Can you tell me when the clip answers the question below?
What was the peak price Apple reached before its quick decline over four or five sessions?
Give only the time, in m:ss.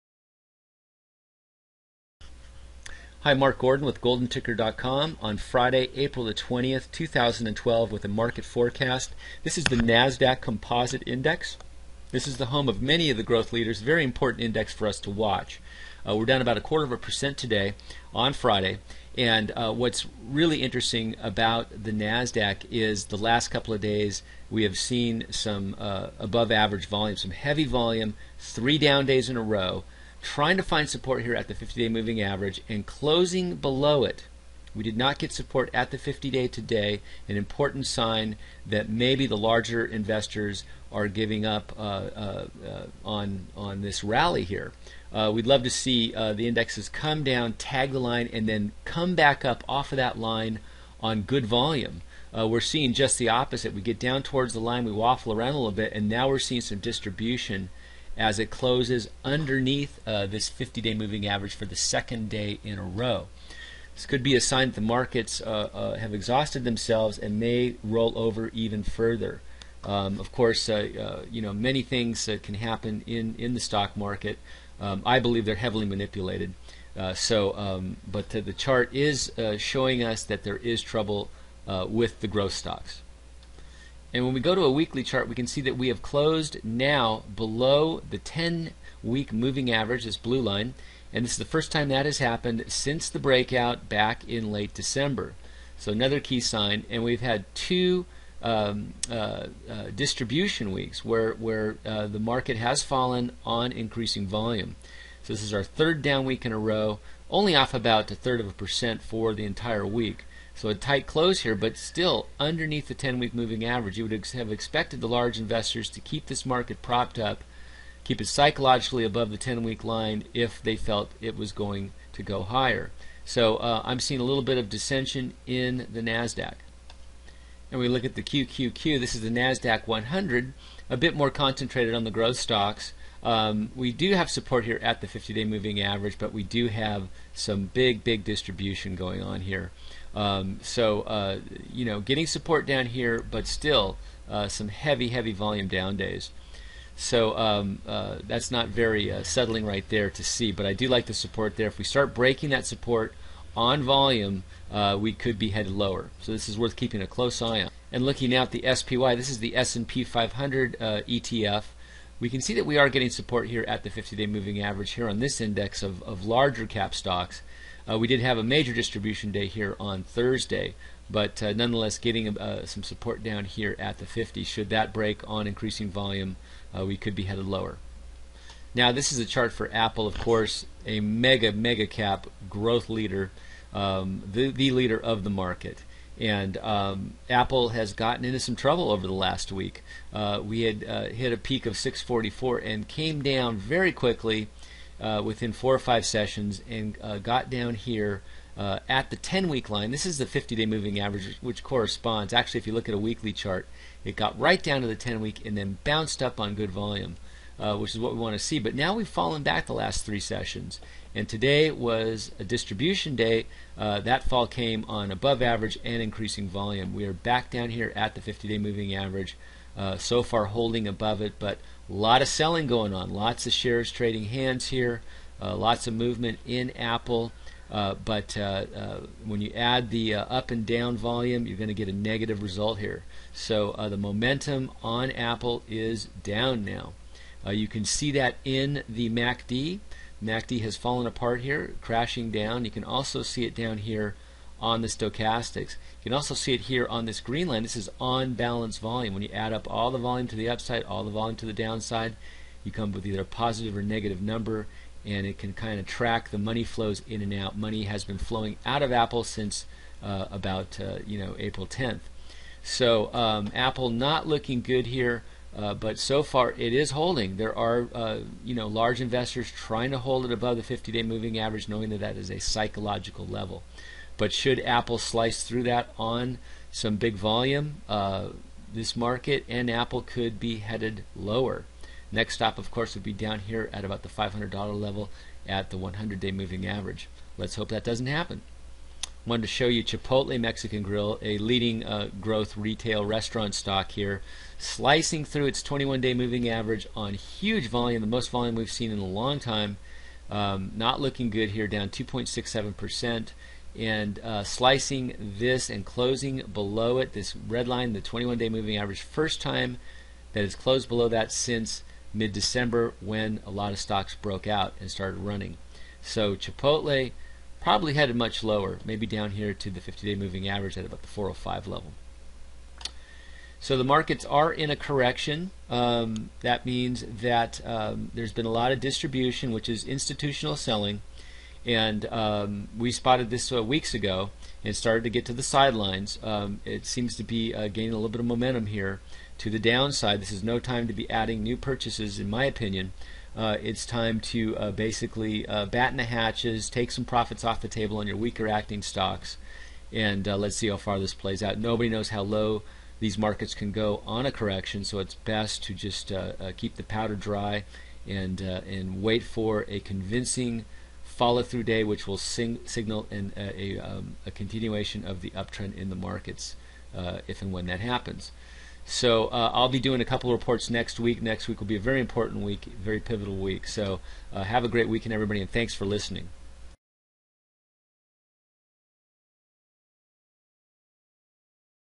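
3:11.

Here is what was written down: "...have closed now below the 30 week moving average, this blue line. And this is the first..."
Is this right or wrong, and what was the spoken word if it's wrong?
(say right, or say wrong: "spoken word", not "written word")
wrong: "10", not "30".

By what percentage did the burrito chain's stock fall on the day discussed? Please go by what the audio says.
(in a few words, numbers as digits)
2.67%.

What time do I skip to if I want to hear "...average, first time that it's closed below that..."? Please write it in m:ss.
5:08.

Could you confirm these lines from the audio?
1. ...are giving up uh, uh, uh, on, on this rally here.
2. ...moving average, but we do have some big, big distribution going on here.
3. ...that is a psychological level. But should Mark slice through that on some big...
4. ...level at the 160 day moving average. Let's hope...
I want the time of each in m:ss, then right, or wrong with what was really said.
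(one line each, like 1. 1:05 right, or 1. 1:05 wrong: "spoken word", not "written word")
1. 0:40 right
2. 2:15 right
3. 4:31 wrong: "Apple", not "Mark"
4. 4:44 wrong: "100", not "160".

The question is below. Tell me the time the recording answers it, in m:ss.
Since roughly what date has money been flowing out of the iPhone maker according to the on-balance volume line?
4:21.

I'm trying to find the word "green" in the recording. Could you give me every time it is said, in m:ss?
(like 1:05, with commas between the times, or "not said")
4:07.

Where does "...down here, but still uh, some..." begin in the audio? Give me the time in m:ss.
2:22.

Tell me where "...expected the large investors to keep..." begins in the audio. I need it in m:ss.
1:54.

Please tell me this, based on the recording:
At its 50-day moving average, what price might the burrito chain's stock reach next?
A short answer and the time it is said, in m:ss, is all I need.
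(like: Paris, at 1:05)
405, at 5:21.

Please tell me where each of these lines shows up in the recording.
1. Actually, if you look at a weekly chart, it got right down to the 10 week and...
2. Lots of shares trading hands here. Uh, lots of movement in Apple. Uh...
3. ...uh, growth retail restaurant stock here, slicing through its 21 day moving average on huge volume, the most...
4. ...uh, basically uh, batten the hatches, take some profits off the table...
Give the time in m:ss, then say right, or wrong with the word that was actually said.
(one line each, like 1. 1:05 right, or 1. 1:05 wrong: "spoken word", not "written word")
1. 3:22 right
2. 3:43 right
3. 4:51 right
4. 5:44 right.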